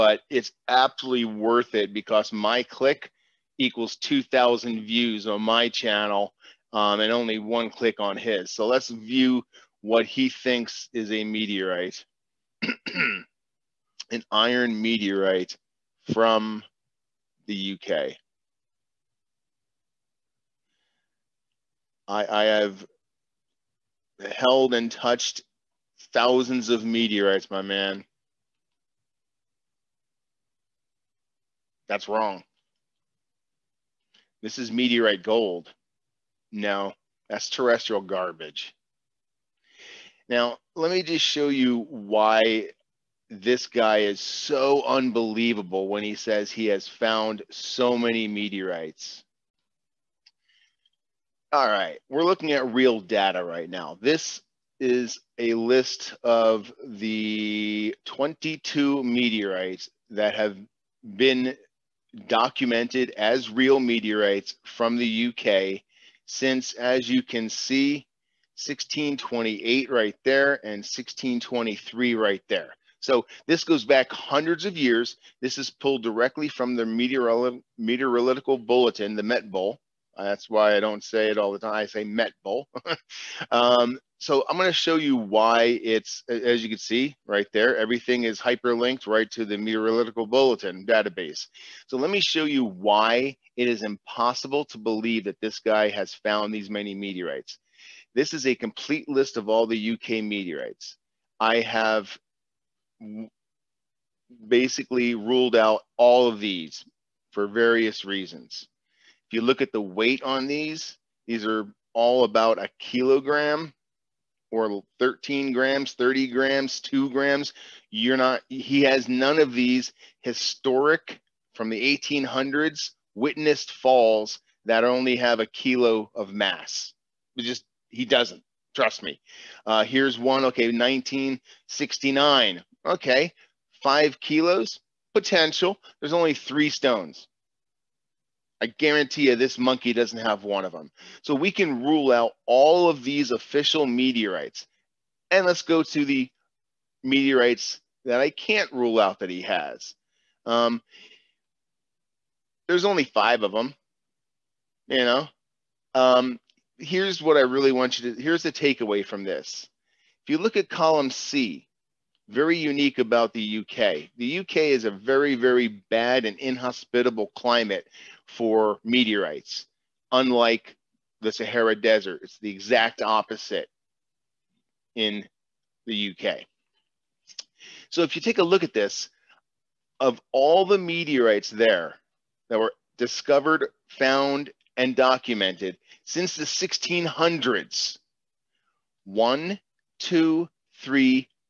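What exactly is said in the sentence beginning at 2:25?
And let's go to the meteorites that I can't rule out that he has.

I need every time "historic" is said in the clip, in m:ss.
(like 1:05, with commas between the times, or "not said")
2:00.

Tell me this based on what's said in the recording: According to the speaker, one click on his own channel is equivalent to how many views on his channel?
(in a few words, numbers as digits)
2,000.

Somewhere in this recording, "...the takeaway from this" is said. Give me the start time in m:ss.
2:38.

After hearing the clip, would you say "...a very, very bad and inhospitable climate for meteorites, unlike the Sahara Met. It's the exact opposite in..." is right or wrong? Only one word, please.
wrong.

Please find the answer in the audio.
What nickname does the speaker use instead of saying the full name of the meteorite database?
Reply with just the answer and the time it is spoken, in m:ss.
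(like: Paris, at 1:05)
Met Bowl, at 1:22.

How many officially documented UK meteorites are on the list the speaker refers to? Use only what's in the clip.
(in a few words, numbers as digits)
22.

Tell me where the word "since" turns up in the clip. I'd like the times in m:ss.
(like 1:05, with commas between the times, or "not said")
1:06, 3:06.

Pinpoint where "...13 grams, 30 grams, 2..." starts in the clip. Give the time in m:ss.
1:54.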